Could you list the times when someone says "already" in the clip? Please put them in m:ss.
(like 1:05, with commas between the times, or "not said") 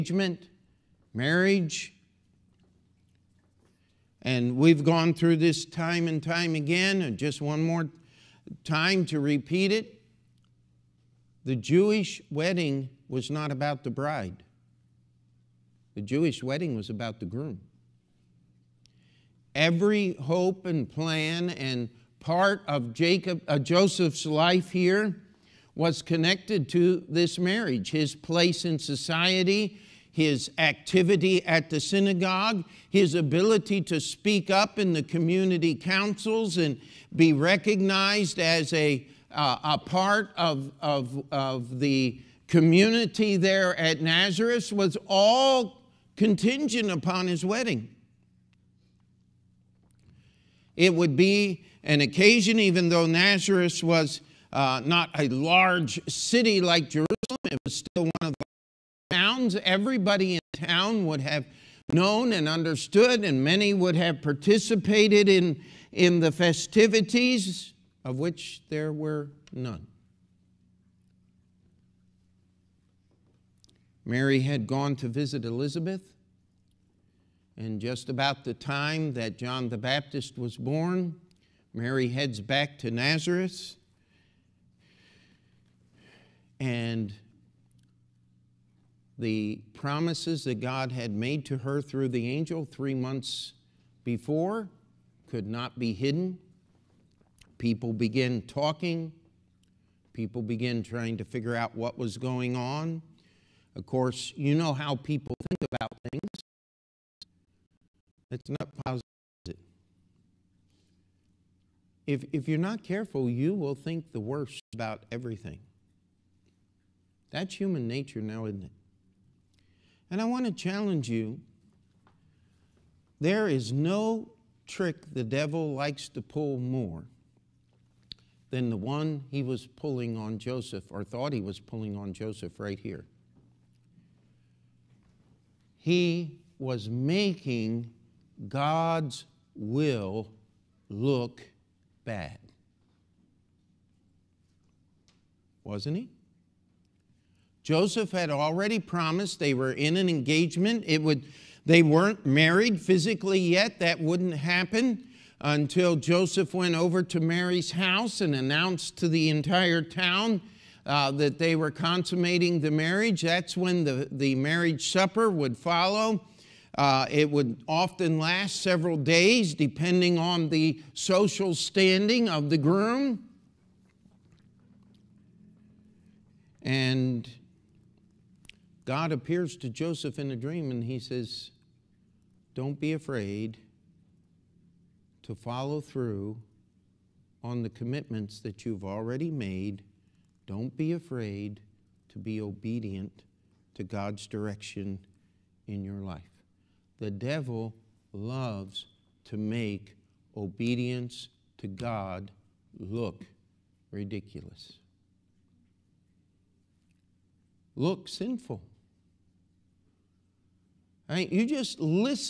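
2:28, 3:08.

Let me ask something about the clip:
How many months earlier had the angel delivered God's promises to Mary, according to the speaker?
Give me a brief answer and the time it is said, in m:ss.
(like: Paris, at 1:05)
3, at 1:32.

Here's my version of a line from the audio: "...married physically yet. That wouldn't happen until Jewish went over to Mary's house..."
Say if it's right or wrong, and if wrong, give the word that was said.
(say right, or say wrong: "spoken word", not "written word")
wrong: "Joseph", not "Jewish".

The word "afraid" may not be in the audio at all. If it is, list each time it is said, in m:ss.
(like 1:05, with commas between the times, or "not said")
3:02, 3:10.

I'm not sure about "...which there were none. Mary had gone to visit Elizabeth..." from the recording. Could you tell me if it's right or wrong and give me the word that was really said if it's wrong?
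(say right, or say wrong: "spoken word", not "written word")
right.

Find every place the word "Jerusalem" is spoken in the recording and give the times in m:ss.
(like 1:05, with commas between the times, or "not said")
0:56.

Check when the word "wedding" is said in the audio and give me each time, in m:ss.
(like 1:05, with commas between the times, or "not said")
0:12, 0:16, 0:47.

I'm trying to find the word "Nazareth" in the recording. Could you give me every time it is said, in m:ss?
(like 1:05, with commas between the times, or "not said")
0:44, 0:53, 1:22.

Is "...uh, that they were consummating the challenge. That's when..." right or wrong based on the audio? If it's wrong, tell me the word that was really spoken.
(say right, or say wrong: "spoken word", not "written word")
wrong: "marriage", not "challenge".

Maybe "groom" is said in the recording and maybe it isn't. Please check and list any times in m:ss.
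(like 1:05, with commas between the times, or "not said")
0:17, 2:52.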